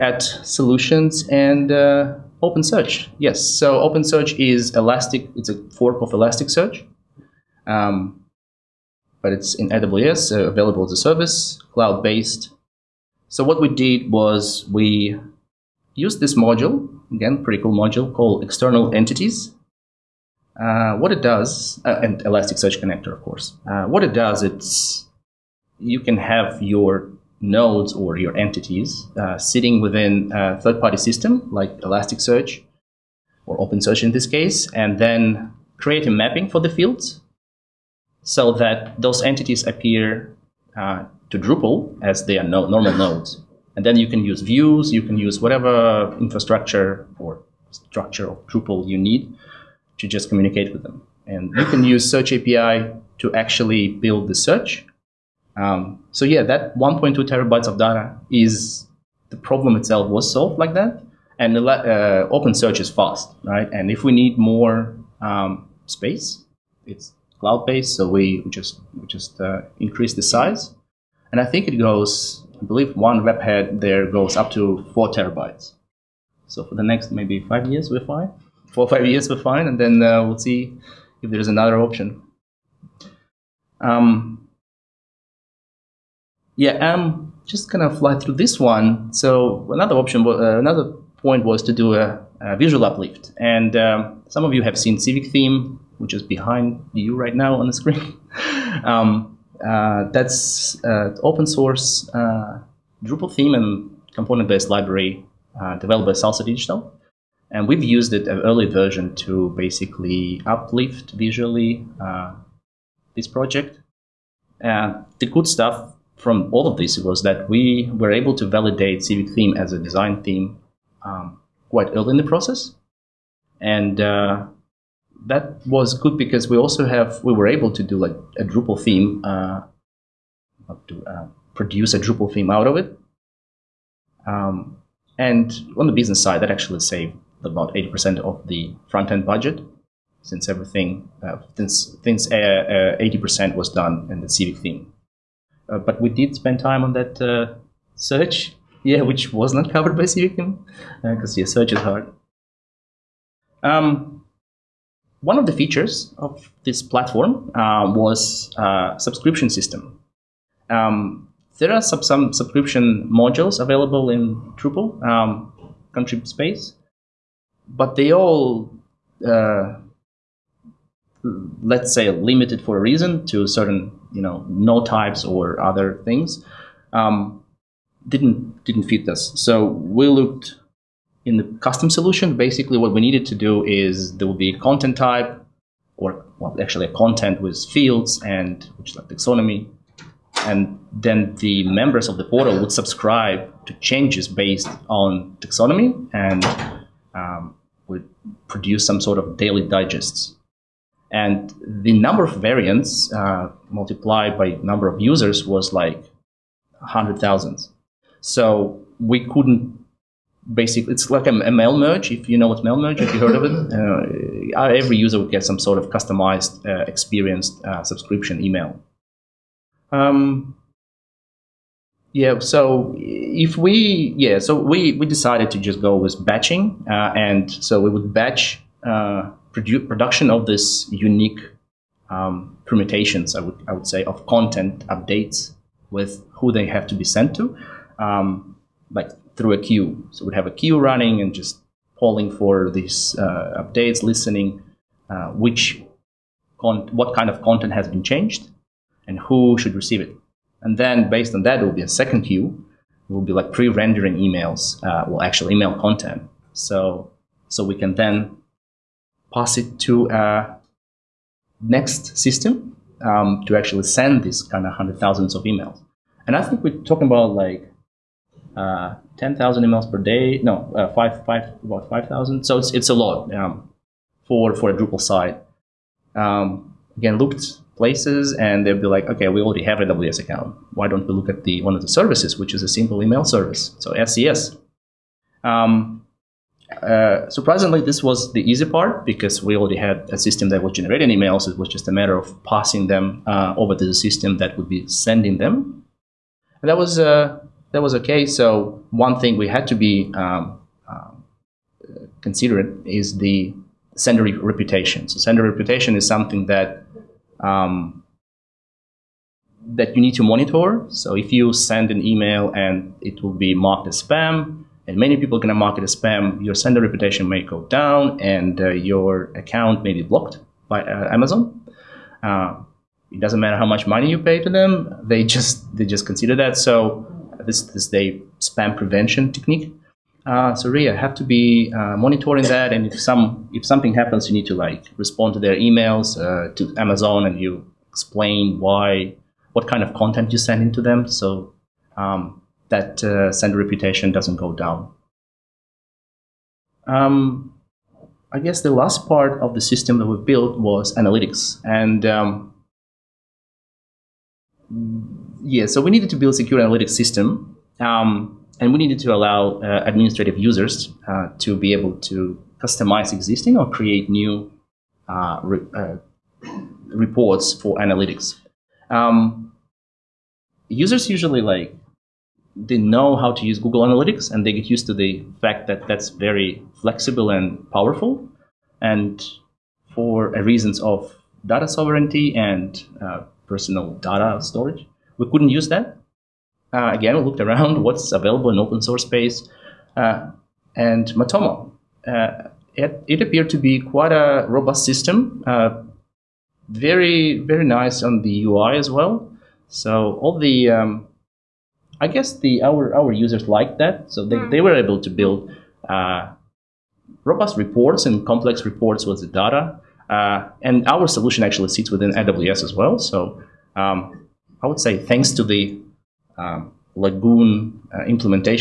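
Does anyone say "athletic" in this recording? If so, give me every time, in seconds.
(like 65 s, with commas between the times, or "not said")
not said.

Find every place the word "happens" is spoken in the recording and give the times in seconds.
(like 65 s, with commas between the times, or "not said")
333 s.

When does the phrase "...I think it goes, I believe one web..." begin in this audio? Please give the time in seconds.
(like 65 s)
71 s.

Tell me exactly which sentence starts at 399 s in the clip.
So all the um, I guess the our our users liked that, so they, mm.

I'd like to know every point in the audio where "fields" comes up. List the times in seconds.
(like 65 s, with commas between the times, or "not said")
36 s, 187 s.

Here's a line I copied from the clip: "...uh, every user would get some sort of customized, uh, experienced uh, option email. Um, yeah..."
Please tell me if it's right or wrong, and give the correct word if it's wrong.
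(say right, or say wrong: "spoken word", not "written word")
wrong: "subscription", not "option".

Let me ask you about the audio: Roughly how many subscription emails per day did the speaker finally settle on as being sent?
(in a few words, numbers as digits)
5,000.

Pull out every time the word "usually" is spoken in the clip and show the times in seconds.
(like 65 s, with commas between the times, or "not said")
371 s.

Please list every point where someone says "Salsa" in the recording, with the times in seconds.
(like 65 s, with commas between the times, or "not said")
106 s.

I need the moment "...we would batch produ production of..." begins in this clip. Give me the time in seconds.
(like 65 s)
227 s.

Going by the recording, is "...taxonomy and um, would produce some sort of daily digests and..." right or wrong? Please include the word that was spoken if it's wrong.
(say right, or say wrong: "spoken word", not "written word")
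right.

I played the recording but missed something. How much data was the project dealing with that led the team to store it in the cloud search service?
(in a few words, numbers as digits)
1.2 terabytes.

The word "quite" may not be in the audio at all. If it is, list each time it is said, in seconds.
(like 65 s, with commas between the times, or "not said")
121 s, 393 s.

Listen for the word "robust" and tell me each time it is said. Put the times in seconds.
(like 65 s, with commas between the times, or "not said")
394 s, 407 s.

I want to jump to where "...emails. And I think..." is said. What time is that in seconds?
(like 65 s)
265 s.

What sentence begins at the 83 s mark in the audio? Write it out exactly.
Um, yeah, I'm just gonna fly through this one.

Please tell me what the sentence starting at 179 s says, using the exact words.
So we looked in the custom solution.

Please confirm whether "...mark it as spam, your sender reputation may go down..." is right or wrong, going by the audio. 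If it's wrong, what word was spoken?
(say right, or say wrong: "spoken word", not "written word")
right.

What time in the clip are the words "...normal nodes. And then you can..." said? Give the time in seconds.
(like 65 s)
42 s.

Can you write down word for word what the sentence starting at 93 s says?
And um, some of you have seen Civic Theme, which is behind you right now on the screen.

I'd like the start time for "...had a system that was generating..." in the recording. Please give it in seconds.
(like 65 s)
289 s.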